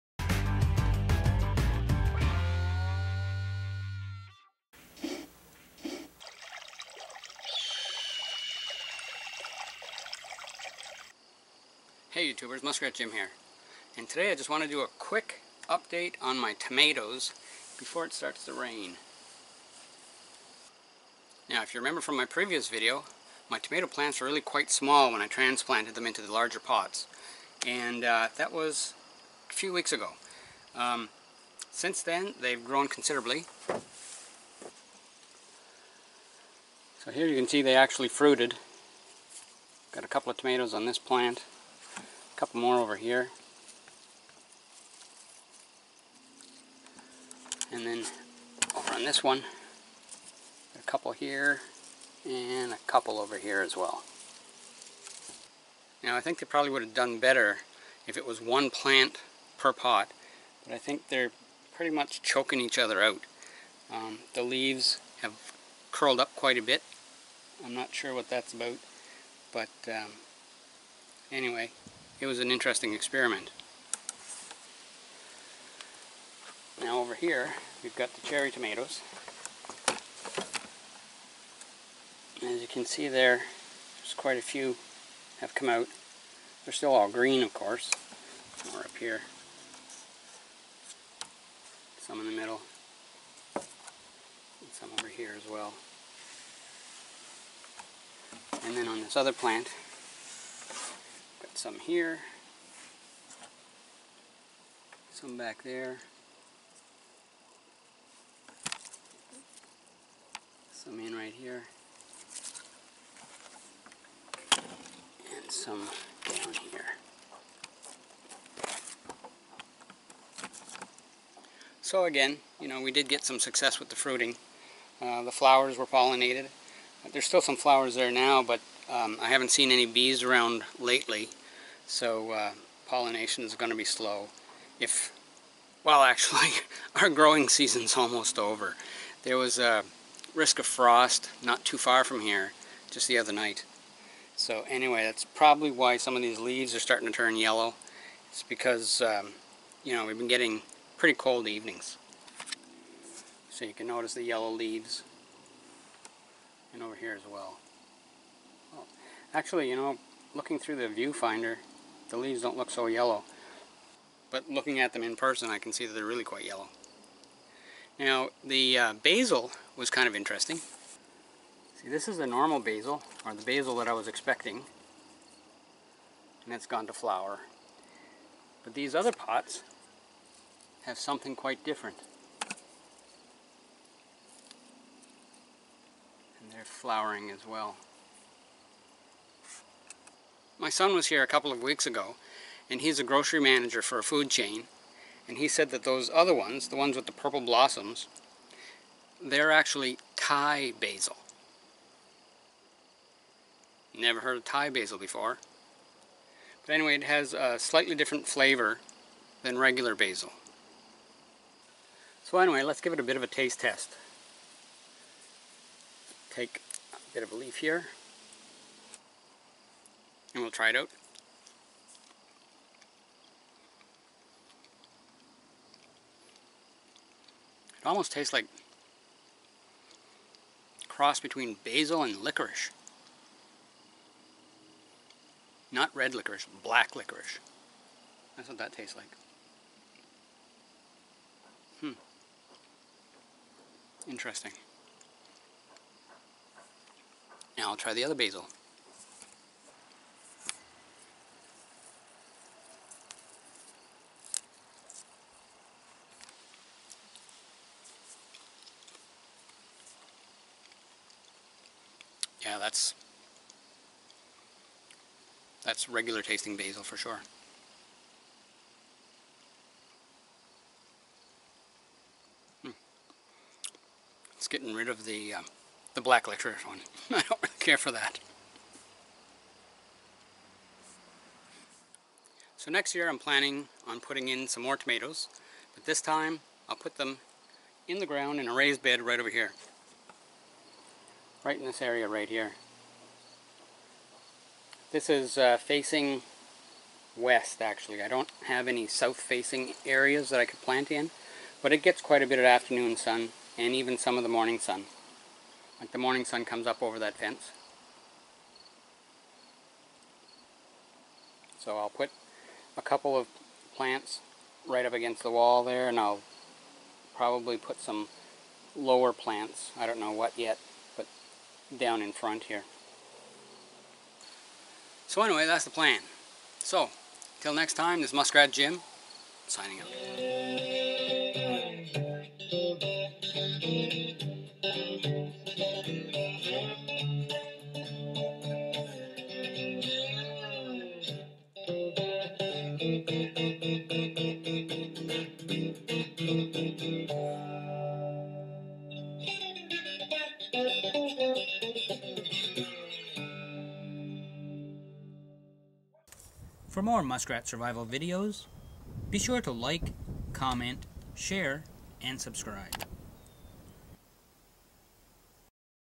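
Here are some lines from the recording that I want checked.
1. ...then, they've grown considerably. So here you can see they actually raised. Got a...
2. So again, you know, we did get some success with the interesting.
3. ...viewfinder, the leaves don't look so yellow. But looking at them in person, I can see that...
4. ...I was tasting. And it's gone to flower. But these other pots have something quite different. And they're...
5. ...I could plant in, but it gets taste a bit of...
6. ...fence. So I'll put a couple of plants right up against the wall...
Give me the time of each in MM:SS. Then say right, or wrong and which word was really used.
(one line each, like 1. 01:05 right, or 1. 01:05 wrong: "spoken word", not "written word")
1. 00:32 wrong: "fruited", not "raised"
2. 02:01 wrong: "fruiting", not "interesting"
3. 02:40 right
4. 02:53 wrong: "expecting", not "tasting"
5. 05:00 wrong: "quite", not "taste"
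6. 05:07 right.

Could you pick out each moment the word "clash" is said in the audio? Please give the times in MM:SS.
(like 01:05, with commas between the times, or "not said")
not said.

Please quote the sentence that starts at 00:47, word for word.
And then over on this one, a couple here and a couple over here as well.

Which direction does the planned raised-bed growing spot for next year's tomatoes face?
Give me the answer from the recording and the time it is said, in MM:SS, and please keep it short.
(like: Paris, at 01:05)
West, at 04:57.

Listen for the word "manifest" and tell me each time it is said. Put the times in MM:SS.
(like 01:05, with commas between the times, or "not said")
not said.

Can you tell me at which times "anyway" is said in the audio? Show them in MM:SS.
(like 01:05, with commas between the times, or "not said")
01:11, 02:24, 03:26, 03:32, 05:25.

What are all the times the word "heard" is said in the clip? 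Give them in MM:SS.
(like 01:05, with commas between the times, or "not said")
03:24.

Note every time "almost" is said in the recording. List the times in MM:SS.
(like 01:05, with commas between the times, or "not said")
02:17, 03:47.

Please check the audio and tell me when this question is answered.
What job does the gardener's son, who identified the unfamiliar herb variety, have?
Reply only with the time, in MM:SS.
03:13.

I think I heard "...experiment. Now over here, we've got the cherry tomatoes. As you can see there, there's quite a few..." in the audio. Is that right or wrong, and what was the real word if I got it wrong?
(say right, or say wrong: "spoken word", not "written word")
right.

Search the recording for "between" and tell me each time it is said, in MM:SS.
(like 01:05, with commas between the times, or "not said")
03:51.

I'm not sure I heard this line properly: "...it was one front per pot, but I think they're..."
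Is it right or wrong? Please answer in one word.
wrong.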